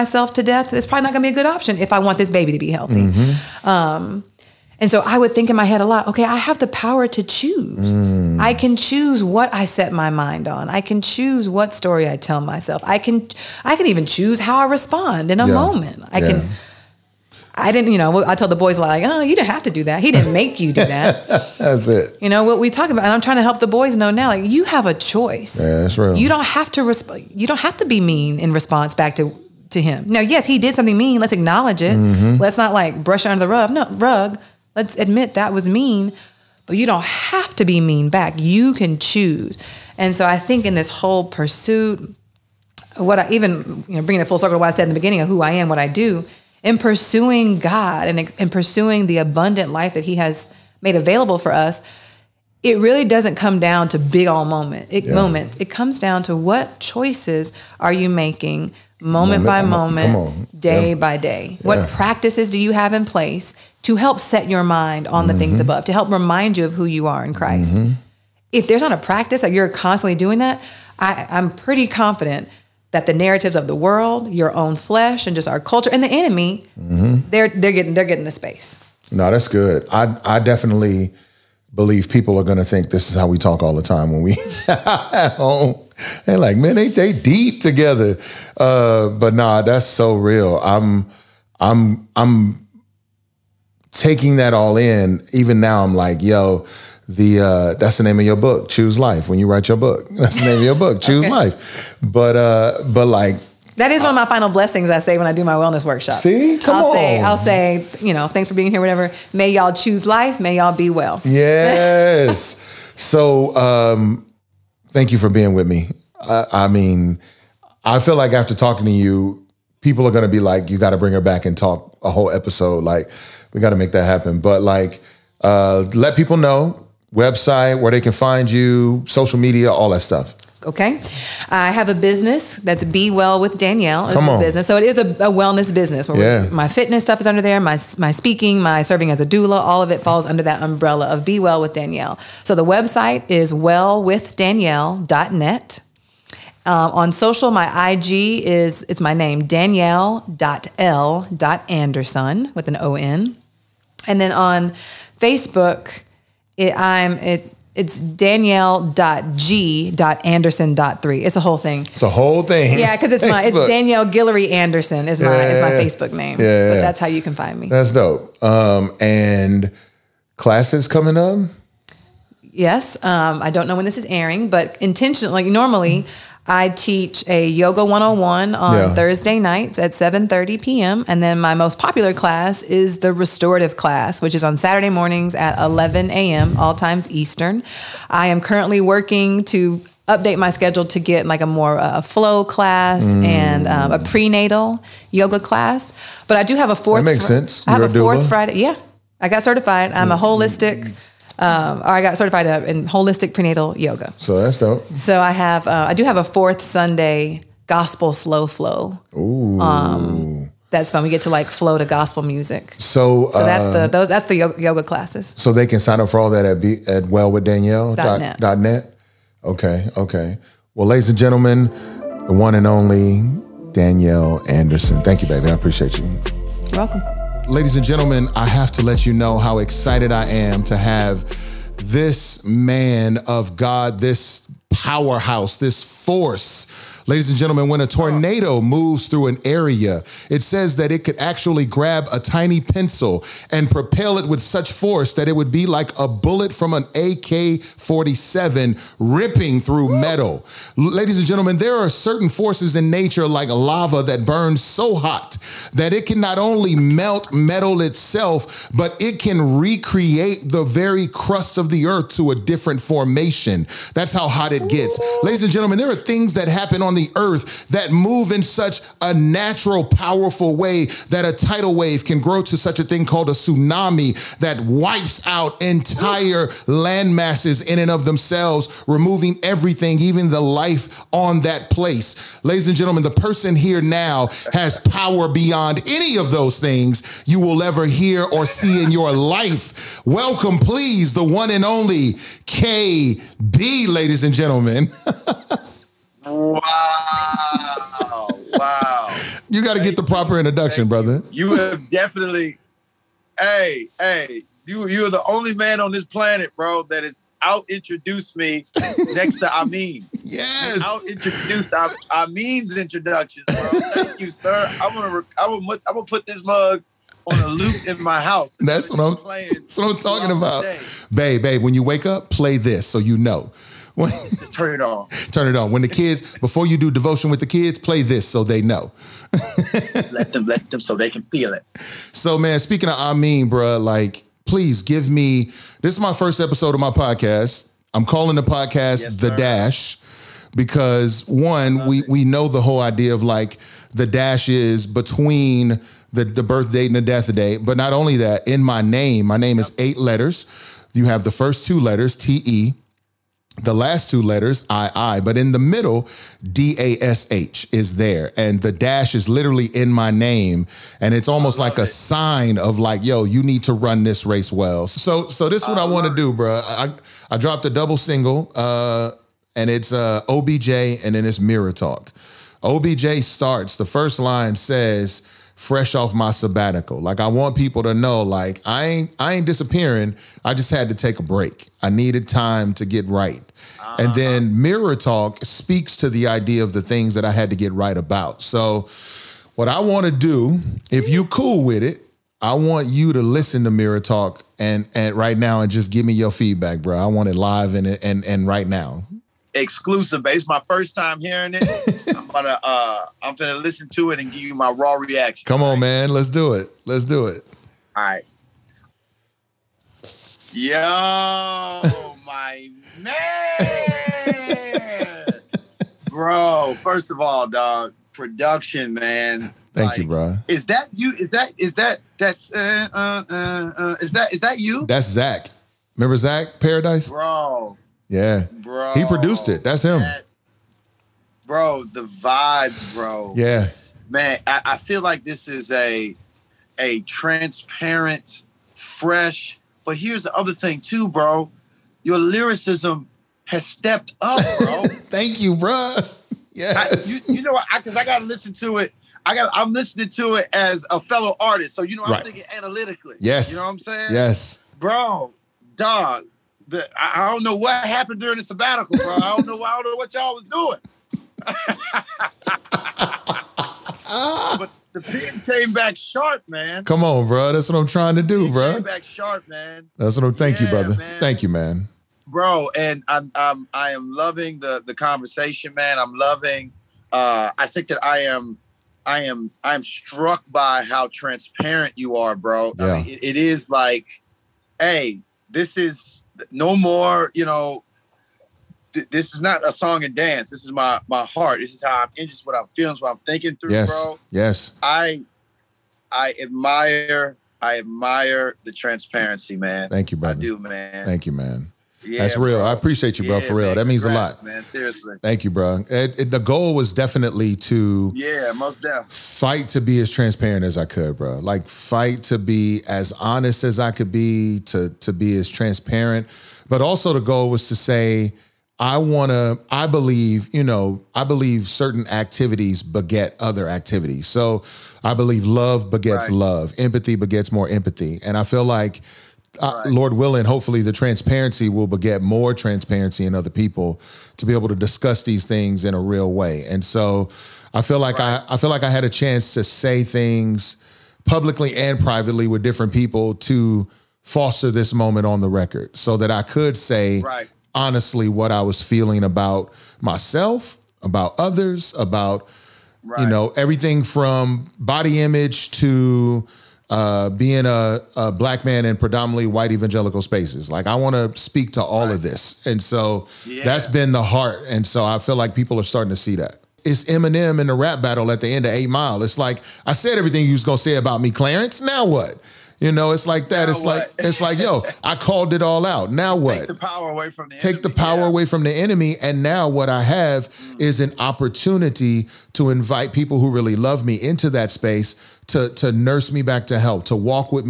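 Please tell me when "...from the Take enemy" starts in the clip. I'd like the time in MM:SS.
09:37.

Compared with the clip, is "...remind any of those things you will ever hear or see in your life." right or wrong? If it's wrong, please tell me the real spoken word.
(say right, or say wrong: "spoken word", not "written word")
wrong: "beyond", not "remind".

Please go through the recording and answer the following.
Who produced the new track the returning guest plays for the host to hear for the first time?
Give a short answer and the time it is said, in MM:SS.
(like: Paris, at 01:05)
Zach Paradise, at 07:06.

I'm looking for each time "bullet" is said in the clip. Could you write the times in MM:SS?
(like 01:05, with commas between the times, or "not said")
04:06.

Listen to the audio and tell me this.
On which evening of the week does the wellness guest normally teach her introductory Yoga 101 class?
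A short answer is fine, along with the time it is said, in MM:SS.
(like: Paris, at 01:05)
Thursday, at 02:58.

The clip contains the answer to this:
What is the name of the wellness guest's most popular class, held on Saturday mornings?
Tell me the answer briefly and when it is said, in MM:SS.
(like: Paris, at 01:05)
restorative class, at 03:03.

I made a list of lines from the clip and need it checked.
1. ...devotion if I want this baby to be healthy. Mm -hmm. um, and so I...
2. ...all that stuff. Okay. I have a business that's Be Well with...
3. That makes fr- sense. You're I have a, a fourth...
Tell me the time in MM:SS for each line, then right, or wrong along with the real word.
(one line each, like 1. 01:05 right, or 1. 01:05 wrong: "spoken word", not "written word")
1. 00:01 wrong: "option", not "devotion"
2. 02:09 right
3. 03:17 right.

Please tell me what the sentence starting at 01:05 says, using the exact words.
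above, to help remind you of who you are in Christ?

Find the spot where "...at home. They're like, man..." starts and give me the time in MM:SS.
01:24.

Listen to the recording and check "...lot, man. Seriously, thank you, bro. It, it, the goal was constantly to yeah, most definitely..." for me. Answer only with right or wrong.
wrong.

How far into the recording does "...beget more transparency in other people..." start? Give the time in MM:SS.
08:51.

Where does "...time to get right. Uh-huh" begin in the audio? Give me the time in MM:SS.
06:22.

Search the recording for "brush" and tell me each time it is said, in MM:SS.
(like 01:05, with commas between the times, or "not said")
00:33.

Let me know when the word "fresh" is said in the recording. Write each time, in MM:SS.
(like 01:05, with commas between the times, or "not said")
06:15, 07:18.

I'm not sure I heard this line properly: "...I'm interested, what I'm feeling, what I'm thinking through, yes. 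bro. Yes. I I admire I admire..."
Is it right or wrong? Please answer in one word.
right.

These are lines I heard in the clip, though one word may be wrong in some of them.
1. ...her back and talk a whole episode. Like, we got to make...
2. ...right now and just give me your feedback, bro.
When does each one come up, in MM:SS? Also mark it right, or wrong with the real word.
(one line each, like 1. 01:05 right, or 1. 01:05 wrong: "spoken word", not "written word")
1. 02:01 right
2. 06:35 right.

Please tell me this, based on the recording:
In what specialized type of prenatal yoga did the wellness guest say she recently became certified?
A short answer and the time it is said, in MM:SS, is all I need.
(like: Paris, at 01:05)
holistic prenatal yoga, at 03:22.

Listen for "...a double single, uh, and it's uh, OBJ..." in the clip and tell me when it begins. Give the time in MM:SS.
06:07.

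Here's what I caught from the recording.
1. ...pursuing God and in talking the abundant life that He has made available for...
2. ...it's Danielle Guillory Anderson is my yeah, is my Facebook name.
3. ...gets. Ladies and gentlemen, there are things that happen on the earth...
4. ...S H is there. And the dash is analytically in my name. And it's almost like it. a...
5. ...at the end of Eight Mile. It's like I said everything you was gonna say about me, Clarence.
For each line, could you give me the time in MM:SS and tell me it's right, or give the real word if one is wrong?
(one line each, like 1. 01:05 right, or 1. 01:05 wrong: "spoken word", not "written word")
1. 00:46 wrong: "pursuing", not "talking"
2. 02:43 right
3. 04:24 right
4. 05:57 wrong: "literally", not "analytically"
5. 09:28 right.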